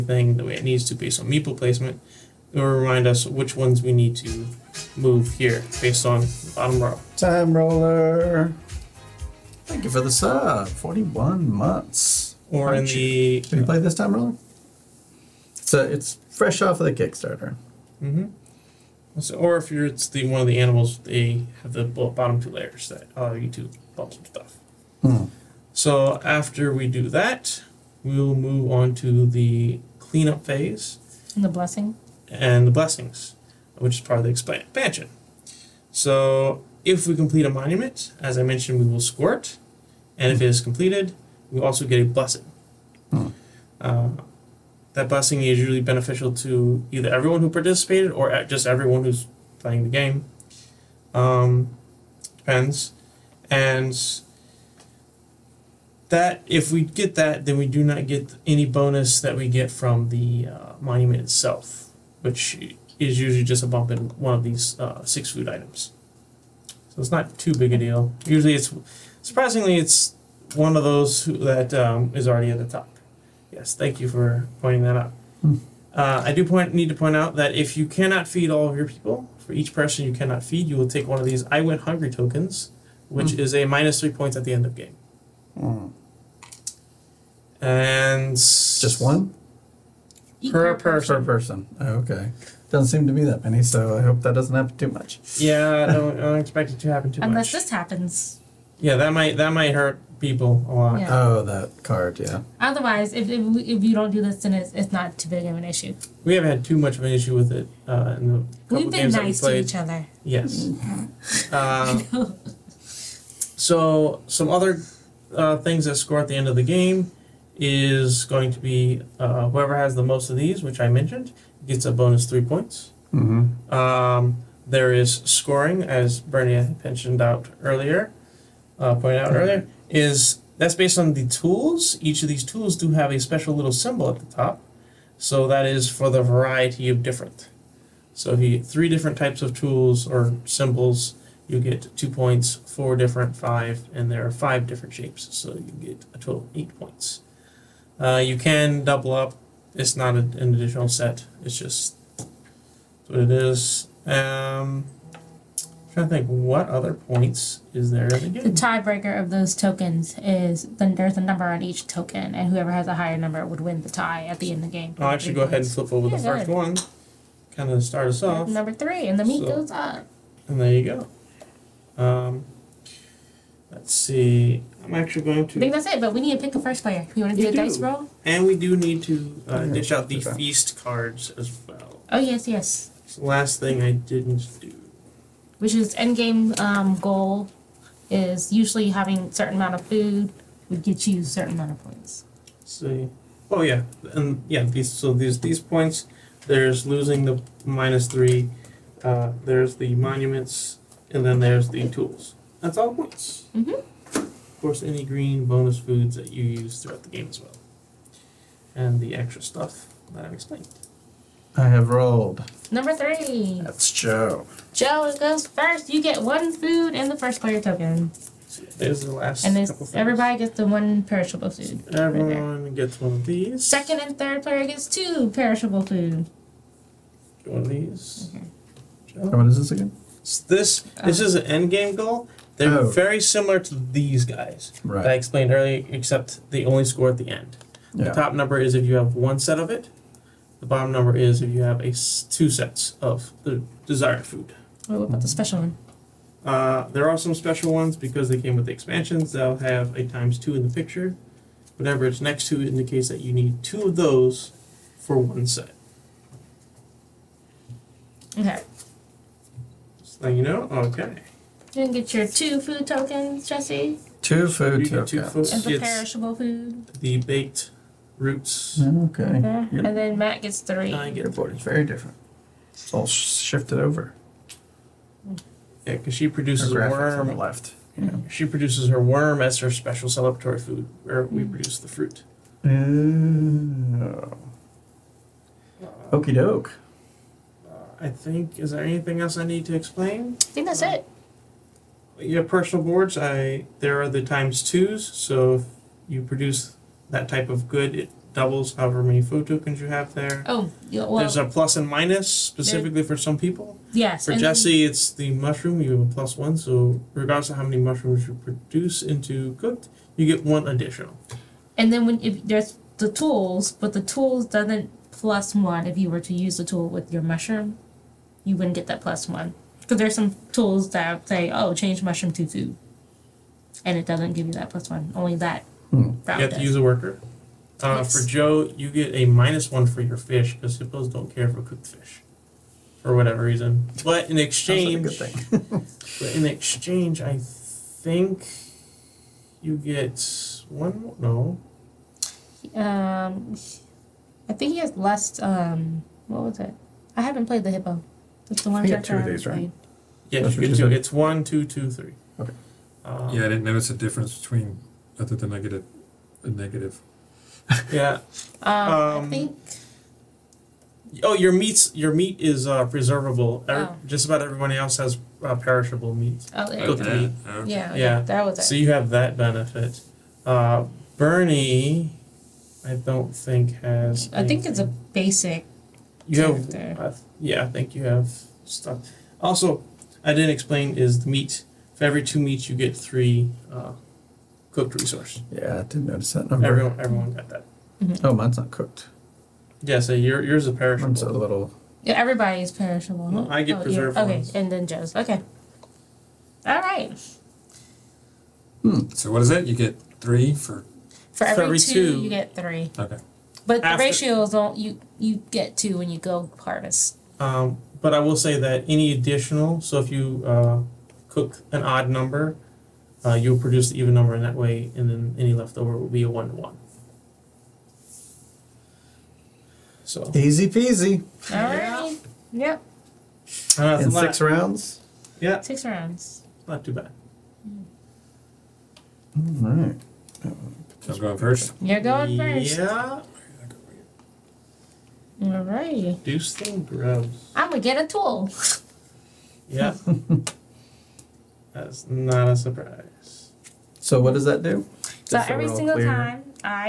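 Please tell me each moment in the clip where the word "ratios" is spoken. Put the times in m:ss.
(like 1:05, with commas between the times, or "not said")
6:44.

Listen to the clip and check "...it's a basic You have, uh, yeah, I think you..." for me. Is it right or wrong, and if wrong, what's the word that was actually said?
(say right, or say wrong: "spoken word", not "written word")
right.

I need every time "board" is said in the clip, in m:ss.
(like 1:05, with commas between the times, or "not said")
4:31, 4:52.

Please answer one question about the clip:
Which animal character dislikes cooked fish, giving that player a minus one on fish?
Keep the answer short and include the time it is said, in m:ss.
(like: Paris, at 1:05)
Hippo, at 5:30.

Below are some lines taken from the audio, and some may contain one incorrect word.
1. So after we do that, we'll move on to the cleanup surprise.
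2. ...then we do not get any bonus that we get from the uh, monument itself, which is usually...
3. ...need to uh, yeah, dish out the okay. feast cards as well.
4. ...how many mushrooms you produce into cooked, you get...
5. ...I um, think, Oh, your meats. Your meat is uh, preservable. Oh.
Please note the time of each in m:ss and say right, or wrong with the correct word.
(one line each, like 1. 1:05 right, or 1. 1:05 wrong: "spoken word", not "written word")
1. 0:25 wrong: "phase", not "surprise"
2. 0:57 right
3. 2:58 right
4. 5:07 right
5. 5:58 right.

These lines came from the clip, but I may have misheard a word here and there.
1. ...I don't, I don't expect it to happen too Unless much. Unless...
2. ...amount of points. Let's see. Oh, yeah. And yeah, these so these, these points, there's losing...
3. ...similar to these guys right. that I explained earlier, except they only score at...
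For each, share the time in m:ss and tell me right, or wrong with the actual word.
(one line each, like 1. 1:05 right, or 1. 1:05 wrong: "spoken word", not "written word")
1. 1:35 right
2. 3:11 right
3. 3:53 right.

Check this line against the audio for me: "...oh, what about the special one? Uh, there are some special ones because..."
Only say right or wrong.
right.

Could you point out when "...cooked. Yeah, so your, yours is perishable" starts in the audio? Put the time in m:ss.
6:28.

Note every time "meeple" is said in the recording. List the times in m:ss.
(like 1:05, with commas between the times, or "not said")
0:01.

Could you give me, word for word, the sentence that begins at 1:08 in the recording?
Usually, it's surprisingly it's one of those who, that um, is already at the top.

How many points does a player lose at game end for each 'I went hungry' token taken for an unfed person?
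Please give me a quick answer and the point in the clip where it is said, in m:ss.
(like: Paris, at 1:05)
3, at 1:23.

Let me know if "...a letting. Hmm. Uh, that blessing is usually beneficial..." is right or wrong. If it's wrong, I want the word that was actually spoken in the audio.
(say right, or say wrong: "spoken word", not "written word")
wrong: "blessing", not "letting".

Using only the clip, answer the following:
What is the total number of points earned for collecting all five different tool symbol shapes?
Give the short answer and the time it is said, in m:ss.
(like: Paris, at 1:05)
8, at 2:26.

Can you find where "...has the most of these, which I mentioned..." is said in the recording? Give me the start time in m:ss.
1:59.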